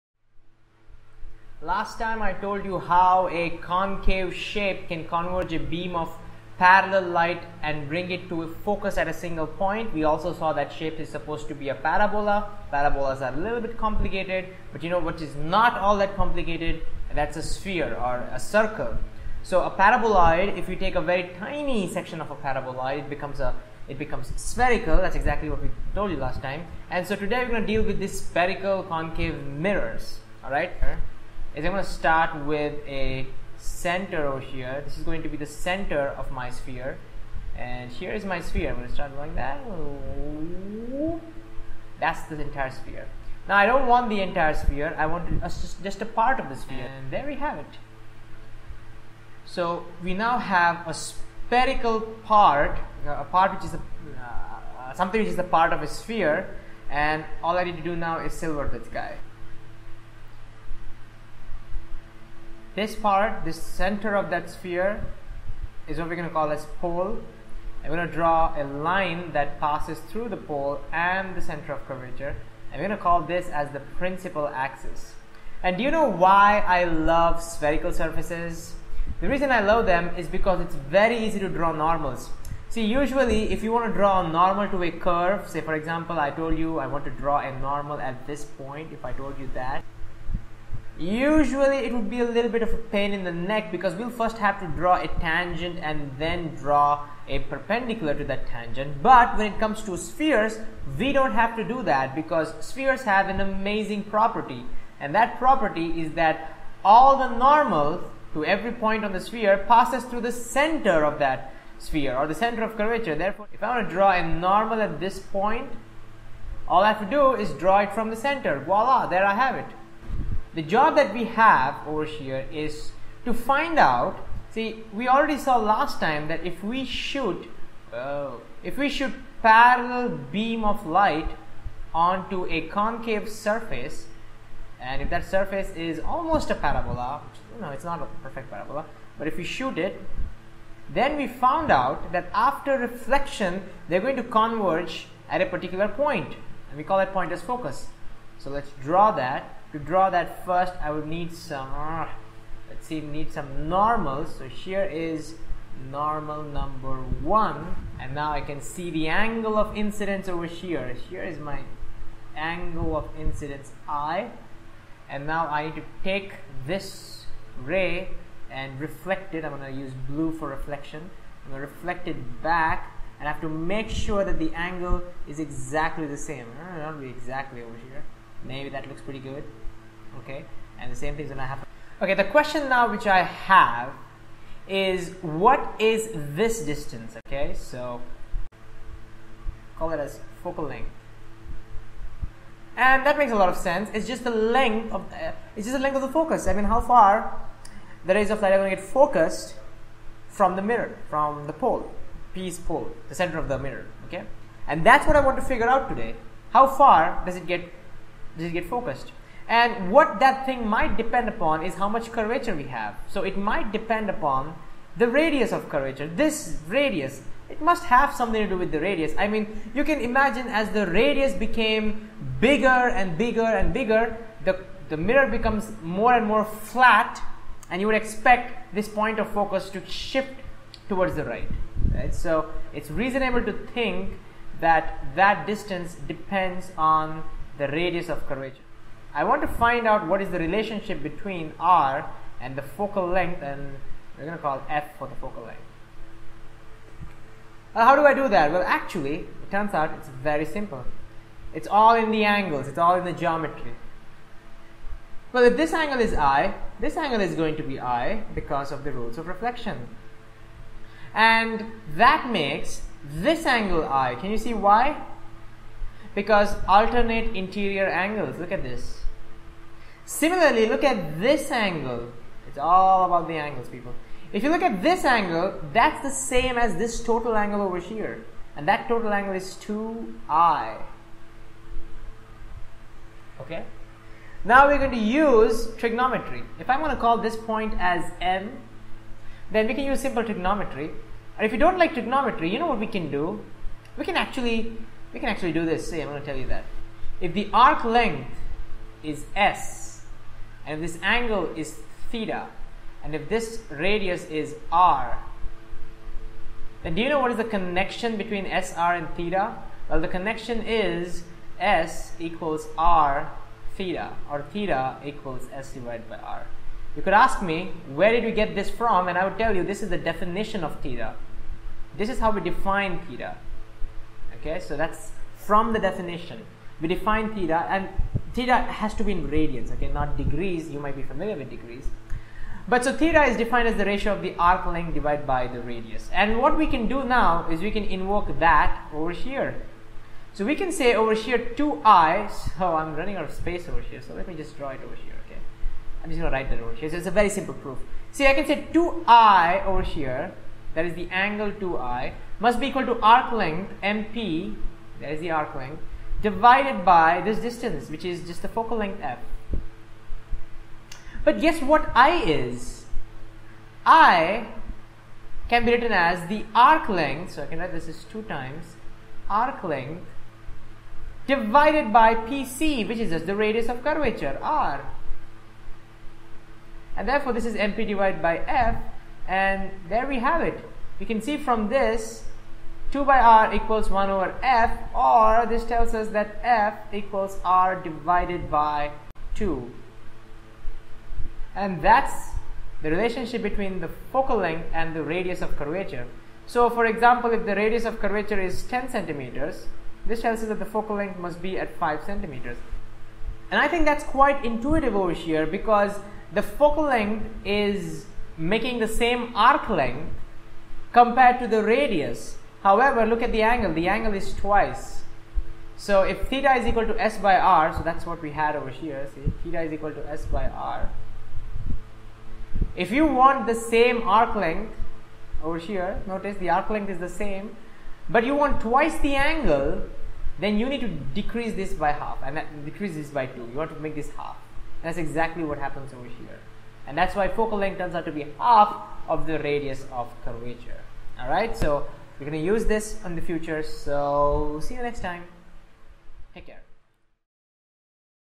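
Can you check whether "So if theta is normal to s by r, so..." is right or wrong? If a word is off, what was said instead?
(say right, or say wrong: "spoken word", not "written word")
wrong: "equal", not "normal".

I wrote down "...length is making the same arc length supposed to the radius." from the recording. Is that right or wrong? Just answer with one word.
wrong.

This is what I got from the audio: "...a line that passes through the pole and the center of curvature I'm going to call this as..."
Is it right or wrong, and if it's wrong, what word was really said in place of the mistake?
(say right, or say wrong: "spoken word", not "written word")
right.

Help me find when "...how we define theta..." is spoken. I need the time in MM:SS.
05:22.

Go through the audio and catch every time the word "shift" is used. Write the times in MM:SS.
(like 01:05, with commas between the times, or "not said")
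03:49.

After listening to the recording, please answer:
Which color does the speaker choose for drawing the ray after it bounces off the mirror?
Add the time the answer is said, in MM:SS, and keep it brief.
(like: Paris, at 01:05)
Blue, at 02:50.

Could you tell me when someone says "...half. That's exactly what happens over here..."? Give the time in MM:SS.
07:14.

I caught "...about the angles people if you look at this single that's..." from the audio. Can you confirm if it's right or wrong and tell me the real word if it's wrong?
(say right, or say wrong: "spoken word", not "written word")
wrong: "angle", not "single".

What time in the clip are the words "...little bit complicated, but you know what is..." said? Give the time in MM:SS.
00:13.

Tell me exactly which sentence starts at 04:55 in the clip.
See, I'm going to tell you that.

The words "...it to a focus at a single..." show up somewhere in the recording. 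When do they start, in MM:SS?
00:08.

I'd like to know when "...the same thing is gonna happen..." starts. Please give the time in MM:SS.
03:00.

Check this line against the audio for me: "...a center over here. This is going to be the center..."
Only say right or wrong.
right.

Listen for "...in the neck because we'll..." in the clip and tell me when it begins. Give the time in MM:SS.
01:33.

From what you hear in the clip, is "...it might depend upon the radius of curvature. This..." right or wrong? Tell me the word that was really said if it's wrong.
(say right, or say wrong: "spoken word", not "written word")
right.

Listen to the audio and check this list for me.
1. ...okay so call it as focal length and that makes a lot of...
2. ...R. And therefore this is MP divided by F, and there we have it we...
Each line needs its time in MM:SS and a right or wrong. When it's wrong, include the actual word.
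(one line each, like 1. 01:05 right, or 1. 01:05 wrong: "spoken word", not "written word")
1. 03:07 right
2. 06:14 right.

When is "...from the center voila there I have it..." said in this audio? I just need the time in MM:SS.
01:57.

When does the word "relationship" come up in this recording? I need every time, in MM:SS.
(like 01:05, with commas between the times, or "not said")
04:00, 06:32.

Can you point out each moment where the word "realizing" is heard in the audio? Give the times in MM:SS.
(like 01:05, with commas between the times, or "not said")
not said.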